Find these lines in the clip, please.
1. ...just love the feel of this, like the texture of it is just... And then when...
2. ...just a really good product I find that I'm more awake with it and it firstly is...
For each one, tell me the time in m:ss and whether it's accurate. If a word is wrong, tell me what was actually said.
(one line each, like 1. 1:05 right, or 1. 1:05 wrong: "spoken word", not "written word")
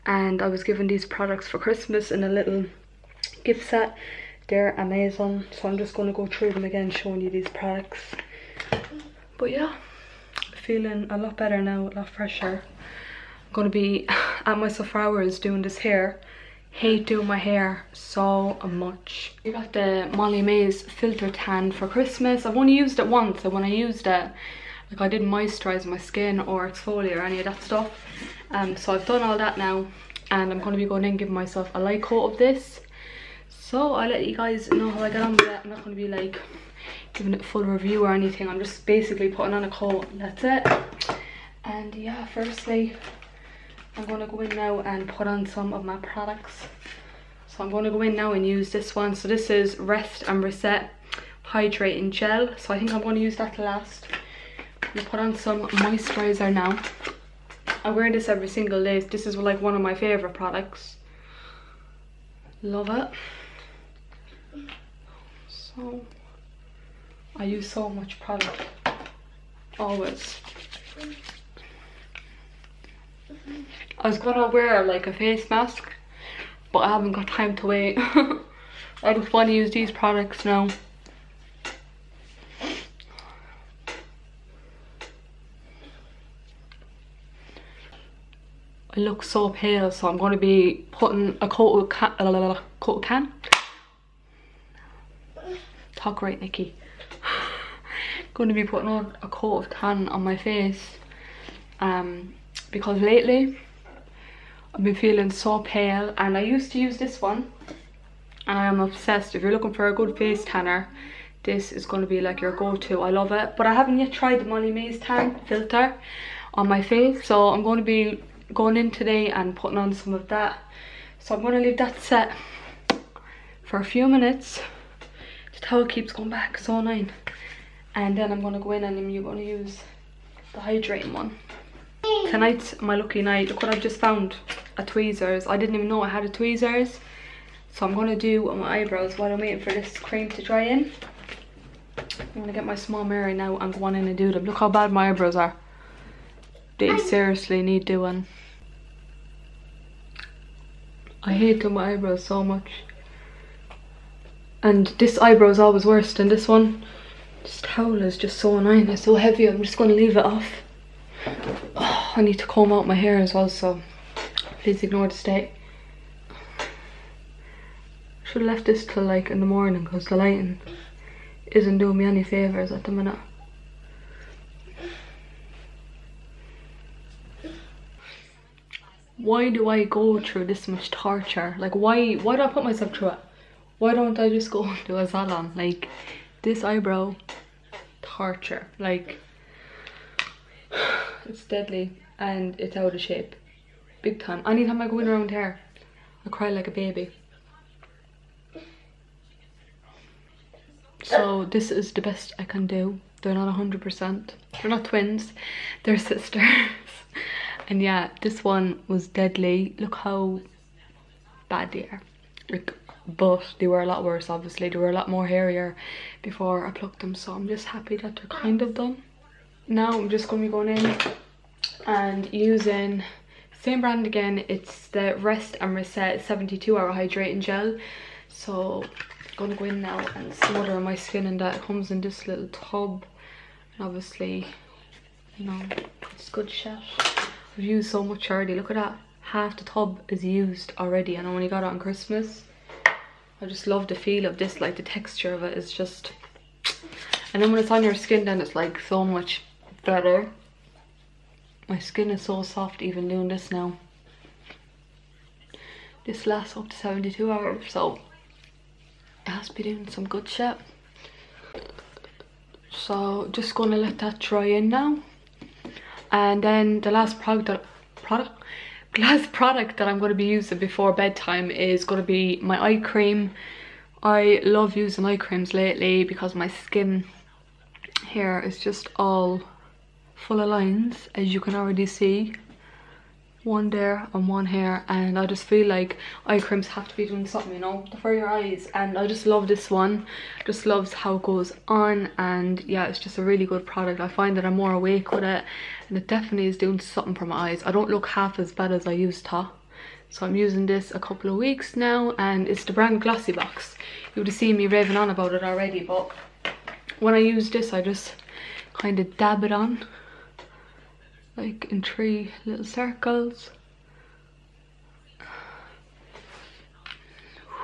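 1. 4:03 right
2. 4:52 wrong: "definitely", not "firstly".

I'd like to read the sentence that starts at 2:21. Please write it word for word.
I'm gonna get my small mirror now and go on in and do them.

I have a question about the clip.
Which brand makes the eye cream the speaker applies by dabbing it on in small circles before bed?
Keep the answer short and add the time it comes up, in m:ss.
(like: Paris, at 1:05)
Glossy Box, at 5:03.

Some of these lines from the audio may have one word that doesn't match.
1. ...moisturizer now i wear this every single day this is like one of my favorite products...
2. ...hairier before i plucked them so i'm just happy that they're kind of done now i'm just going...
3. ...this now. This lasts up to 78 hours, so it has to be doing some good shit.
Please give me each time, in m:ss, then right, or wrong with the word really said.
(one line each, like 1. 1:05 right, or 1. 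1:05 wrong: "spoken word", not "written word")
1. 0:55 right
2. 3:35 right
3. 4:13 wrong: "72", not "78".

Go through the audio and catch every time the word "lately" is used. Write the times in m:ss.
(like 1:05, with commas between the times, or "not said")
1:42, 4:35.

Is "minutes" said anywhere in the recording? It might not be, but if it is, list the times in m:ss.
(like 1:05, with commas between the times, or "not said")
2:04, 2:52.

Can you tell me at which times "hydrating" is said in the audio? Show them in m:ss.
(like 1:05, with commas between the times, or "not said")
0:51, 2:10, 3:46.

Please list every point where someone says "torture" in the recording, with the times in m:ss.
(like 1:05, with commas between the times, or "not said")
3:00, 3:08.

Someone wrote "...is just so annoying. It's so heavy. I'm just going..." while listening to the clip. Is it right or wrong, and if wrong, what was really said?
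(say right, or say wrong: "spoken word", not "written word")
right.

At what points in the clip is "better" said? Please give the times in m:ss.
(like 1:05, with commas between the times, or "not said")
0:11, 4:09.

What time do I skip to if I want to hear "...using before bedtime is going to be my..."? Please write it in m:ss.
4:30.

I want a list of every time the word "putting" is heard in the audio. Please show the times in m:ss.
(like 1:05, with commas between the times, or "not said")
0:39, 1:30, 1:38, 1:59.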